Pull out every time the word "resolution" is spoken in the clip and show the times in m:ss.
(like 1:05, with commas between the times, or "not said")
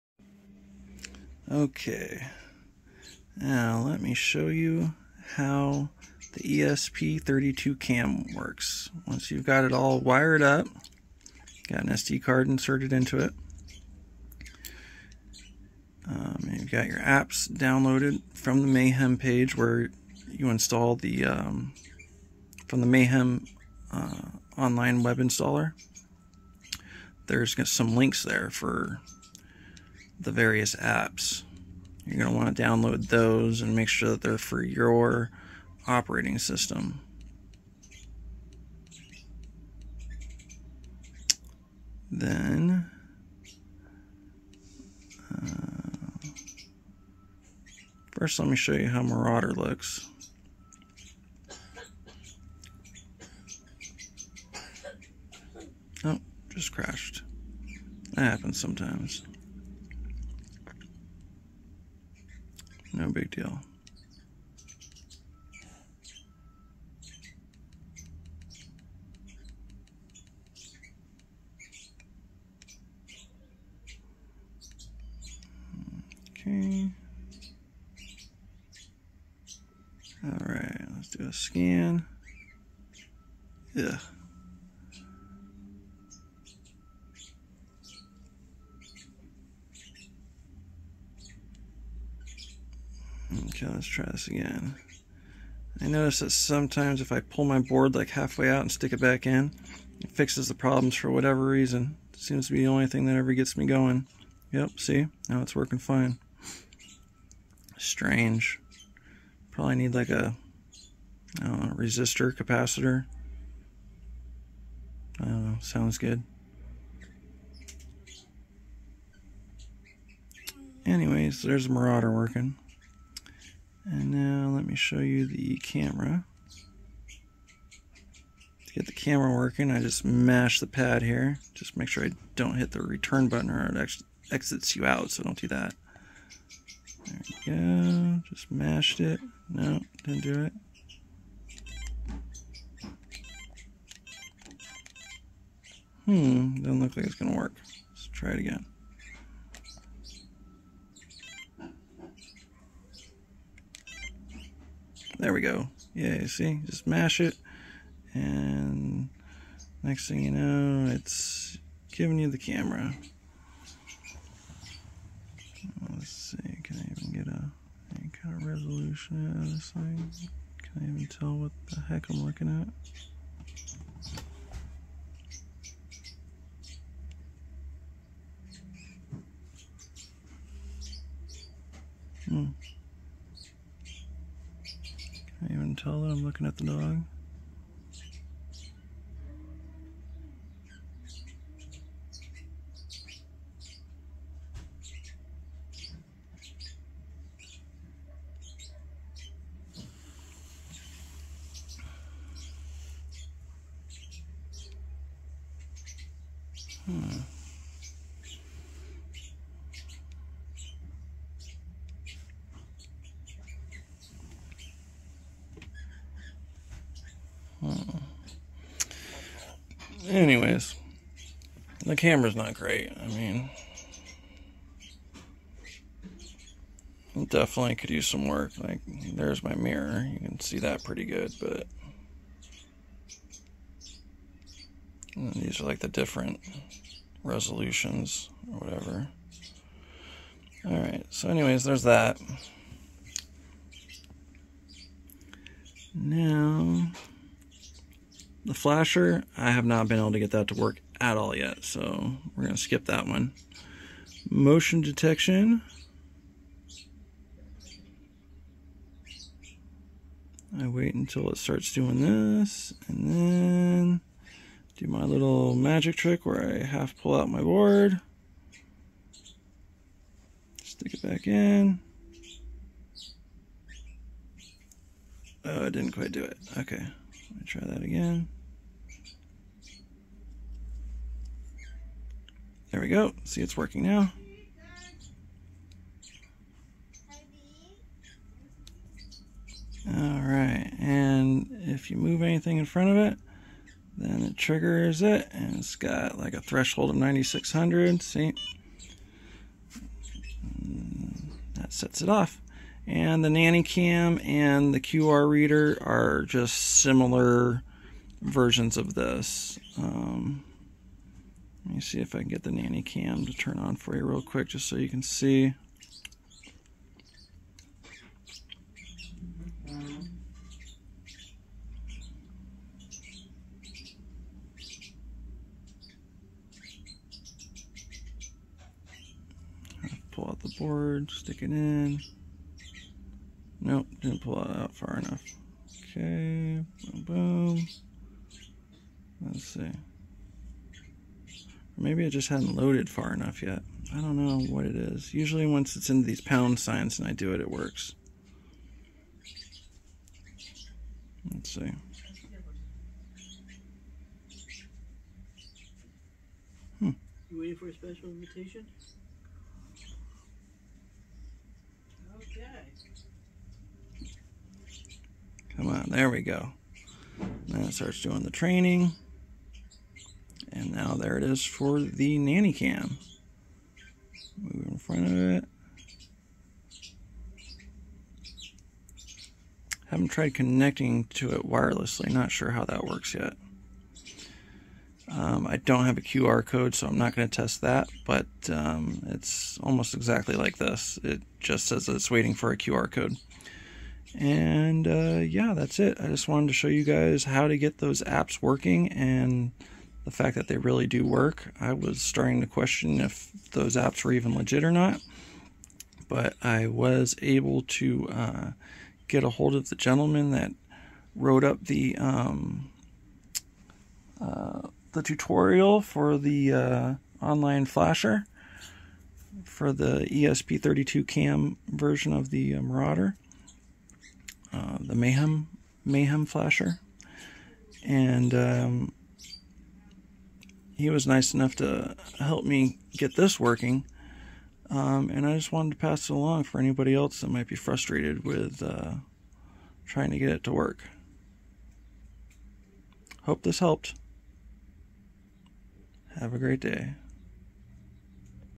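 2:48, 3:57.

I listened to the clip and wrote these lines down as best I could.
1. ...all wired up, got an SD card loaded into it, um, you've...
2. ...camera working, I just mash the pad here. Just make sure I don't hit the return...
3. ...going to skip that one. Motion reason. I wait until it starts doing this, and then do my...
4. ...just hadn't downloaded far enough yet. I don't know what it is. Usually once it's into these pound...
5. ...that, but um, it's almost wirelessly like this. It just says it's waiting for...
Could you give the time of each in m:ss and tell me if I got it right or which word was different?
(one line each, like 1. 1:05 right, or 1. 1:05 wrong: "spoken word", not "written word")
1. 0:09 wrong: "inserted", not "loaded"
2. 2:08 right
3. 4:12 wrong: "detection", not "reason"
4. 5:42 wrong: "loaded", not "downloaded"
5. 6:27 wrong: "exactly", not "wirelessly".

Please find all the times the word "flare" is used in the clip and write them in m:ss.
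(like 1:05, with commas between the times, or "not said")
not said.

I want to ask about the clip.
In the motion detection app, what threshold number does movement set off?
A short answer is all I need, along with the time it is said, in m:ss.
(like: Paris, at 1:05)
9600, at 4:56.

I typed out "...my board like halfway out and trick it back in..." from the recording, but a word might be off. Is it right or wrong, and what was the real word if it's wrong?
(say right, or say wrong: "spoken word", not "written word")
wrong: "stick", not "trick".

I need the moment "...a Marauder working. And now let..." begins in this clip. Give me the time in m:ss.
2:01.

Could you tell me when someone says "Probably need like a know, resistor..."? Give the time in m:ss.
1:49.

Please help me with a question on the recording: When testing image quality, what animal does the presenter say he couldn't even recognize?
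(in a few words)
The dog.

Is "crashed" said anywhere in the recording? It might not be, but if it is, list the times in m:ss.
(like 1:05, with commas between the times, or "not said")
0:56.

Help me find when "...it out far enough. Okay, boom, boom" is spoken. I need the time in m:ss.
5:34.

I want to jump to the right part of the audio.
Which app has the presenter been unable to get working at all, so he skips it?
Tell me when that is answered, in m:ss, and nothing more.
4:08.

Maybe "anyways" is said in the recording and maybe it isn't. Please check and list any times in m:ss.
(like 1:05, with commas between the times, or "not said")
2:00, 3:40, 4:01.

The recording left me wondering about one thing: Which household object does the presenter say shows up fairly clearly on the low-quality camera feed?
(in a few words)
Mirror.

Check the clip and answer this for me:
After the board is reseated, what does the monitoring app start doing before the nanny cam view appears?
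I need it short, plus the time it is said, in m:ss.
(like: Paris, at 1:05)
Training, at 6:08.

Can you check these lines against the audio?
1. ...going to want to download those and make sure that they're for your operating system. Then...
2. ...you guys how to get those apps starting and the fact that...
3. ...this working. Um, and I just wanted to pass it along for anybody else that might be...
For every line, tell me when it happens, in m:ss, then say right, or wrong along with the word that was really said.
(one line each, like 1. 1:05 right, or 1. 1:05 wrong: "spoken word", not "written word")
1. 0:32 right
2. 6:36 wrong: "working", not "starting"
3. 7:13 right.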